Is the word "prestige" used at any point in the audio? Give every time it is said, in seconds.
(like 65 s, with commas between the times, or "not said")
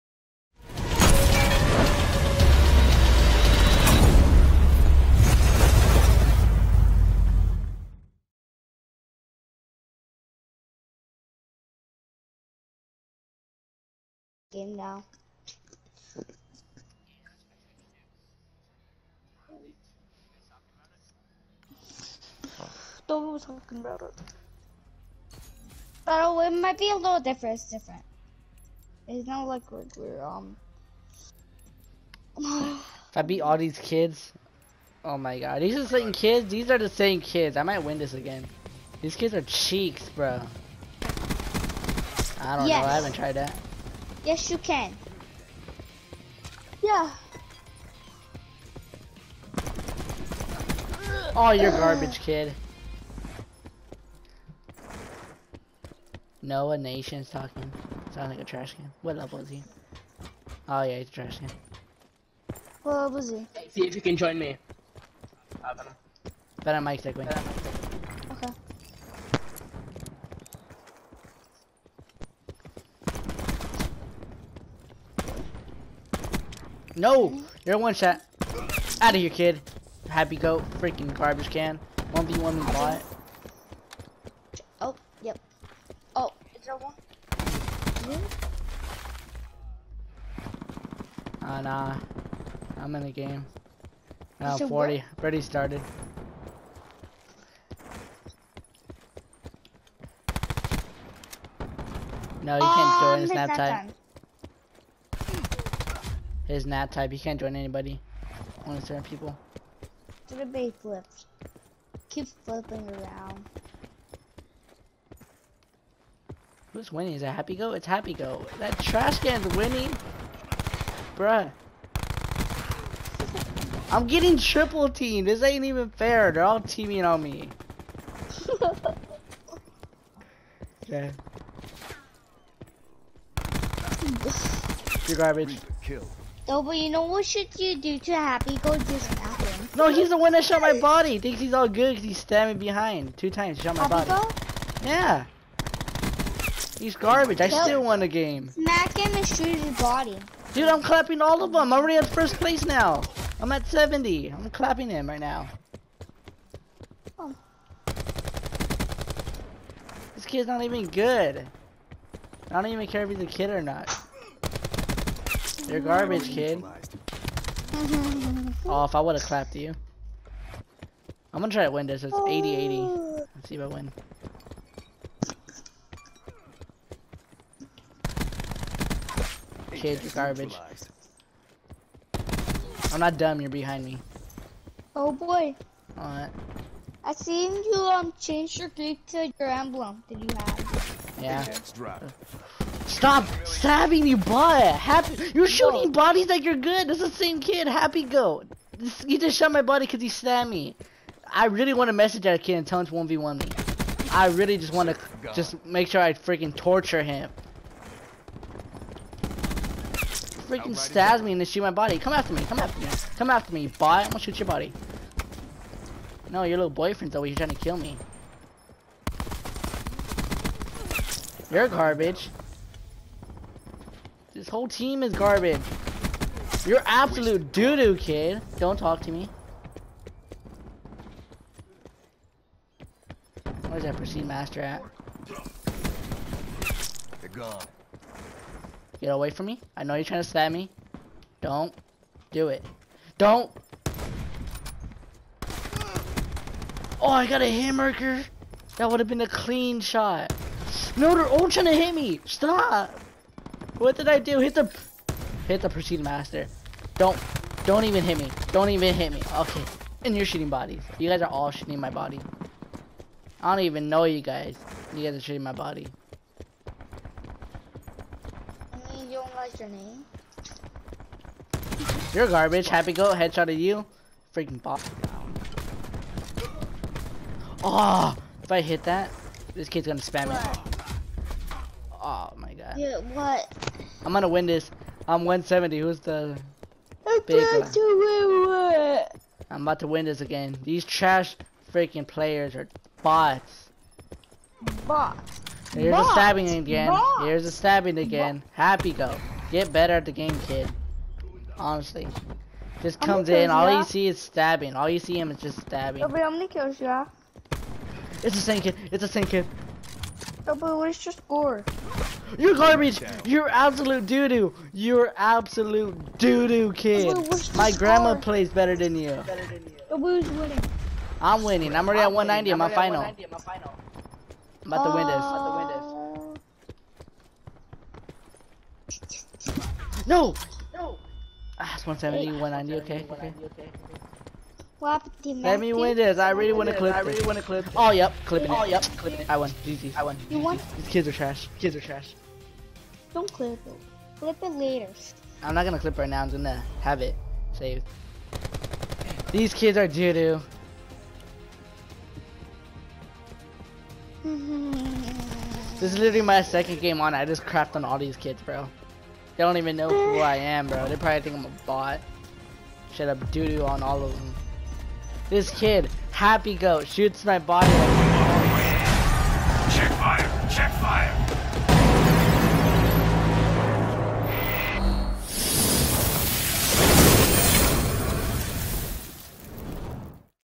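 233 s, 255 s.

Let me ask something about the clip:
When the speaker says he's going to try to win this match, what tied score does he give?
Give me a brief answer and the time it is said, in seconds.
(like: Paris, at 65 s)
80-80, at 172 s.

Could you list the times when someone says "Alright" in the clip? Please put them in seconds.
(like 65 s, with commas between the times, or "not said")
185 s.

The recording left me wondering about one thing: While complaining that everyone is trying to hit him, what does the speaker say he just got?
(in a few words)
Hamburger.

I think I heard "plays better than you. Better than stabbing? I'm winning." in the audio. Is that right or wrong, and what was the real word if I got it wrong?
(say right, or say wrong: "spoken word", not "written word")
wrong: "winning", not "stabbing".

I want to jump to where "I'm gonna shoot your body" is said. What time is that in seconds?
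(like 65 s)
214 s.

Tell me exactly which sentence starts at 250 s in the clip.
No, they're all trying to hit me.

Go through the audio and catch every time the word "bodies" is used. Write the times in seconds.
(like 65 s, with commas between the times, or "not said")
195 s, 260 s.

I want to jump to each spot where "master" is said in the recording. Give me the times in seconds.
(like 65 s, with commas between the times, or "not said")
234 s, 255 s.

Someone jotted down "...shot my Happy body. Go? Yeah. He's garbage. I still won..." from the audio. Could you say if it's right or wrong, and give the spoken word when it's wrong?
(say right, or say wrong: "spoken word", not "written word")
right.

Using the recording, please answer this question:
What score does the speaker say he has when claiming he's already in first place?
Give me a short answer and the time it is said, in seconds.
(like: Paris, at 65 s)
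70, at 153 s.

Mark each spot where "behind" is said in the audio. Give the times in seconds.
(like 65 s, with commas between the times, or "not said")
142 s, 183 s.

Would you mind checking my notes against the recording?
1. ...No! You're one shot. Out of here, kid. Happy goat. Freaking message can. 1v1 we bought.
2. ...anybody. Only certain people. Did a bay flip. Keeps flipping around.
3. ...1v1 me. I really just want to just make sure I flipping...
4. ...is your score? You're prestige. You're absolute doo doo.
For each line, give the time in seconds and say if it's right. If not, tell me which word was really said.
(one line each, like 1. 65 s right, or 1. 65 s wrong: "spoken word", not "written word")
1. 76 s wrong: "garbage", not "message"
2. 107 s right
3. 202 s wrong: "freaking", not "flipping"
4. 310 s wrong: "garbage", not "prestige".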